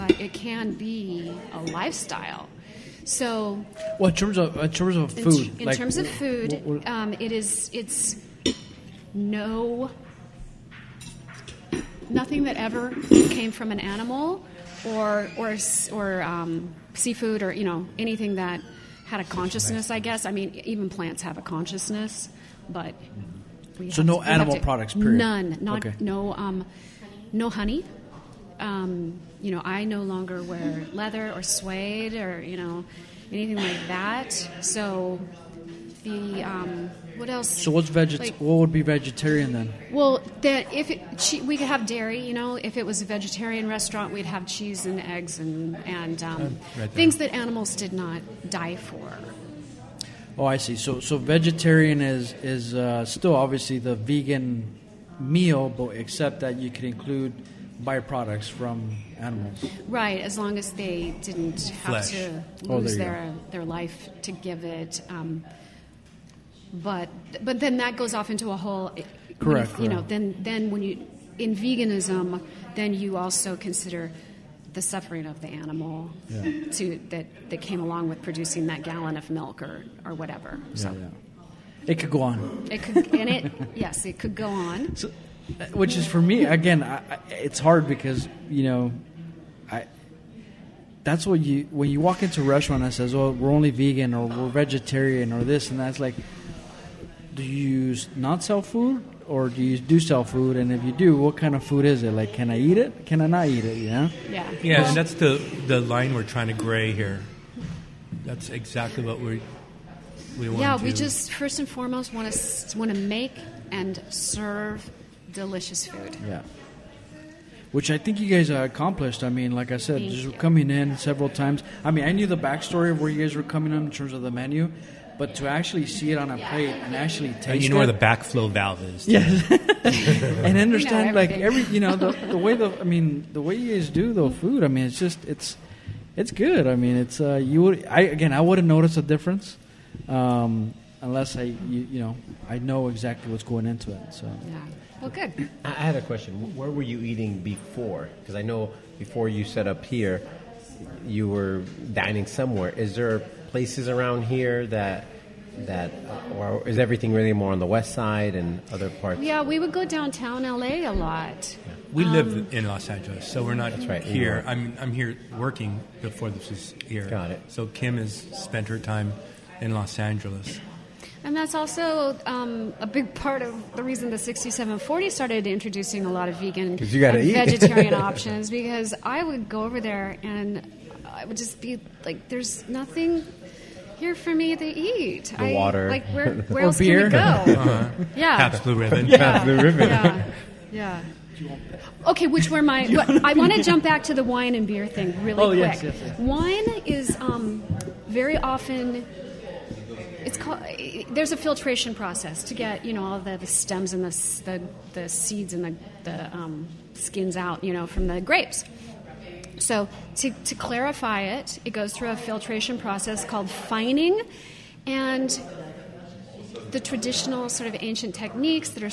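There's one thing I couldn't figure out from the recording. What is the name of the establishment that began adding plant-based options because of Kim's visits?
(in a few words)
The 6740.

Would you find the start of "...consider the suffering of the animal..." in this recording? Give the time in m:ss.
1:13.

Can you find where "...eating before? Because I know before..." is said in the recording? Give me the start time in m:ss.
2:26.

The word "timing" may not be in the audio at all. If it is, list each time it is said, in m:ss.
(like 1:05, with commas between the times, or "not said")
not said.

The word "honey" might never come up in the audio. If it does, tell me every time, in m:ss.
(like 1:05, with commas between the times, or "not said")
0:27.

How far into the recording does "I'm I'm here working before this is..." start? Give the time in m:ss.
2:44.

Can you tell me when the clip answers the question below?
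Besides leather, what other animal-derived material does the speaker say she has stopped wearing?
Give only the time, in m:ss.
0:31.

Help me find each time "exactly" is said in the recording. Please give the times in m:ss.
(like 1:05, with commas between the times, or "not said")
1:48, 2:22.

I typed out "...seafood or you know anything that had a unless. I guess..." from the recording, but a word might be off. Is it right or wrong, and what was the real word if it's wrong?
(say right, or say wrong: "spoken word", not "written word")
wrong: "consciousness", not "unless".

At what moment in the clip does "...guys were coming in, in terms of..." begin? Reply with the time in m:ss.
2:03.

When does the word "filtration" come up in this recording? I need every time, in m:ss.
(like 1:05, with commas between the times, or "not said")
3:21, 3:32.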